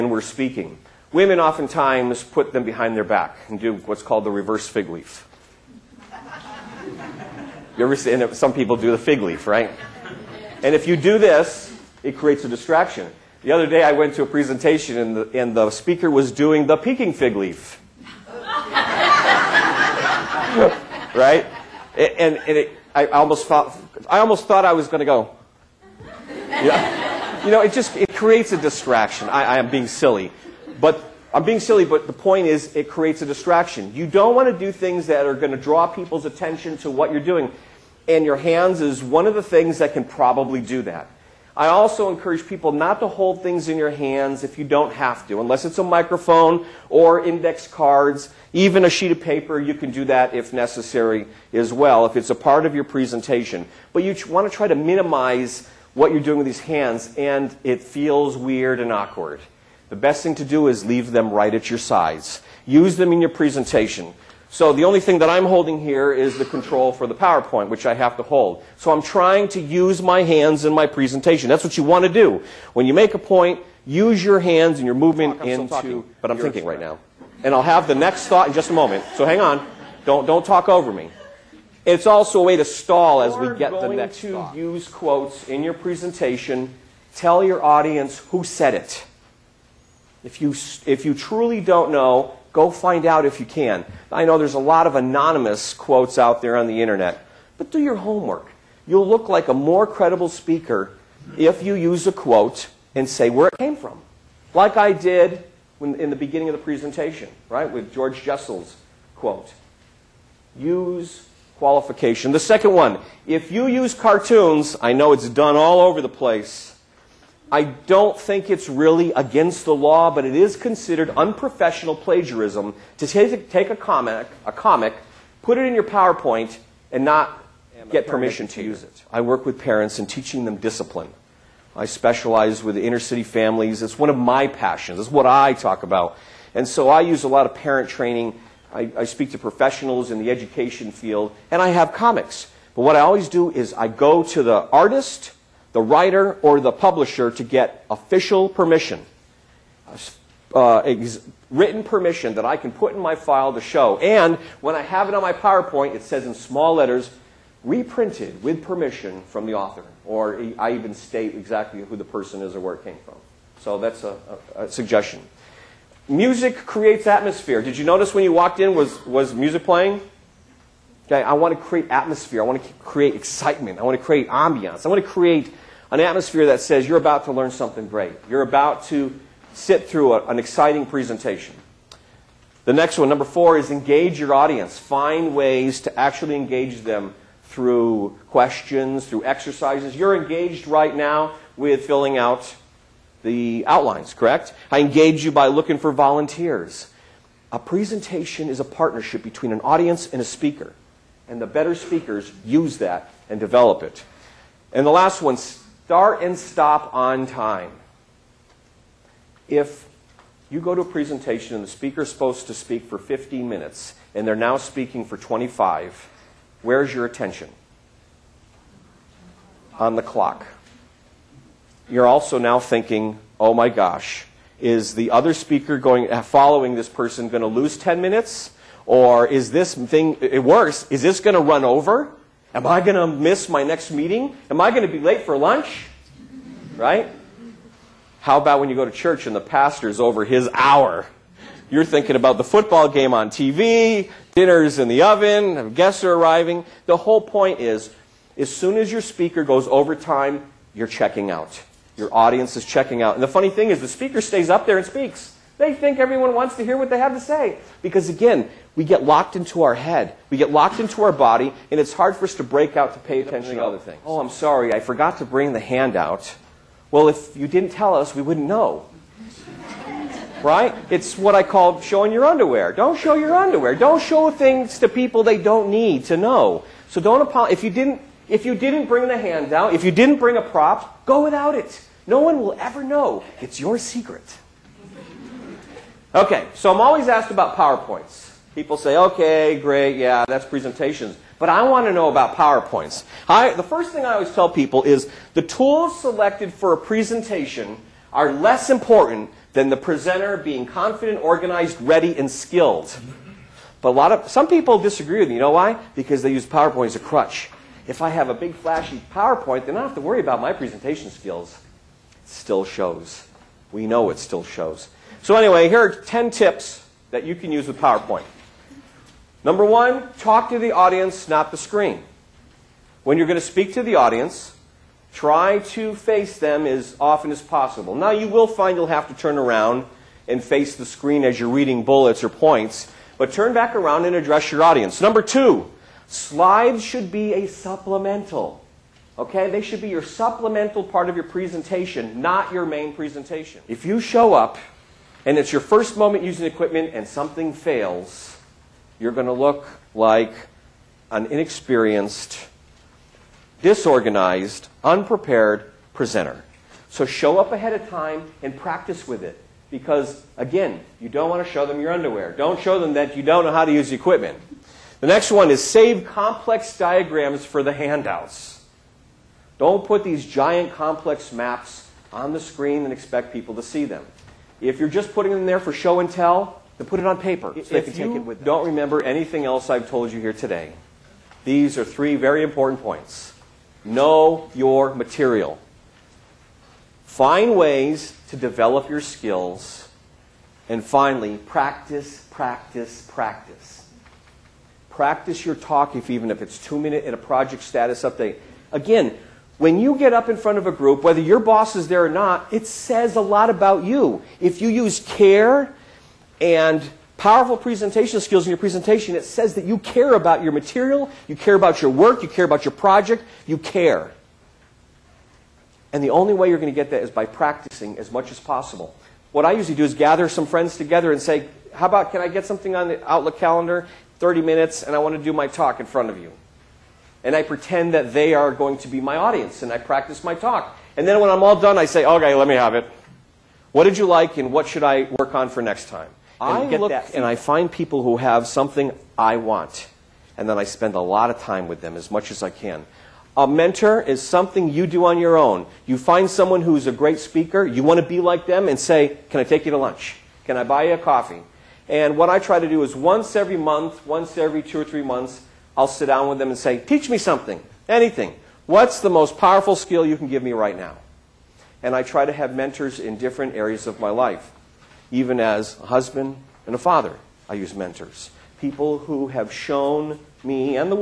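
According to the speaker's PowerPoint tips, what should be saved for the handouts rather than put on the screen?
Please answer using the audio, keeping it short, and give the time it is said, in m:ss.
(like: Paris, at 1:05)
complex diagrams, at 6:06.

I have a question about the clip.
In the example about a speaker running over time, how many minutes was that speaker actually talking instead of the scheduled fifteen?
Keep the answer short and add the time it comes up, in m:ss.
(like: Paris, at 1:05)
25, at 3:35.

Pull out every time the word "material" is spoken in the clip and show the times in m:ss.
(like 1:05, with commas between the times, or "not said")
6:24, 6:50.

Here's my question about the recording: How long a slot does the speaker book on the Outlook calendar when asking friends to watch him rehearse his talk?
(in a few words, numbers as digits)
30 minutes.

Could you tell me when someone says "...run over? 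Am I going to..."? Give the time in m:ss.
3:51.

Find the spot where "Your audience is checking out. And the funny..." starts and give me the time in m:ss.
4:11.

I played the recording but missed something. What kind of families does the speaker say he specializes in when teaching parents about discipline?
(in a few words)
inner city families.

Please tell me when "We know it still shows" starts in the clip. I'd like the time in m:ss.
5:13.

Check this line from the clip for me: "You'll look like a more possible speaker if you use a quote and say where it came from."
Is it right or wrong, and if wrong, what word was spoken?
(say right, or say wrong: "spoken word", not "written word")
wrong: "credible", not "possible".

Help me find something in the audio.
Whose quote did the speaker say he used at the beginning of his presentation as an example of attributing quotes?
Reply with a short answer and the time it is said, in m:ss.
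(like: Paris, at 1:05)
George Jessel, at 1:47.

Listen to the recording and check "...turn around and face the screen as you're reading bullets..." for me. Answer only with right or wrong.
right.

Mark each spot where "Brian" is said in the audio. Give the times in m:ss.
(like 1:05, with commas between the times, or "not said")
not said.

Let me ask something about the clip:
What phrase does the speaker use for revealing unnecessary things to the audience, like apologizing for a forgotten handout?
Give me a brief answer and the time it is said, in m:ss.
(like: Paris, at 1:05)
showing your underwear, at 4:31.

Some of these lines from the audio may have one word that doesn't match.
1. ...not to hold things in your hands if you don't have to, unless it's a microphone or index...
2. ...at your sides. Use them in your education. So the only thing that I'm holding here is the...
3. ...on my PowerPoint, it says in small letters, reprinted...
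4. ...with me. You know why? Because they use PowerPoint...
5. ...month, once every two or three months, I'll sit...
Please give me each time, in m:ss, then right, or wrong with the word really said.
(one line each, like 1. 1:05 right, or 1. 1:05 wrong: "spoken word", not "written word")
1. 0:42 right
2. 1:01 wrong: "presentation", not "education"
3. 2:35 right
4. 5:05 right
5. 7:33 right.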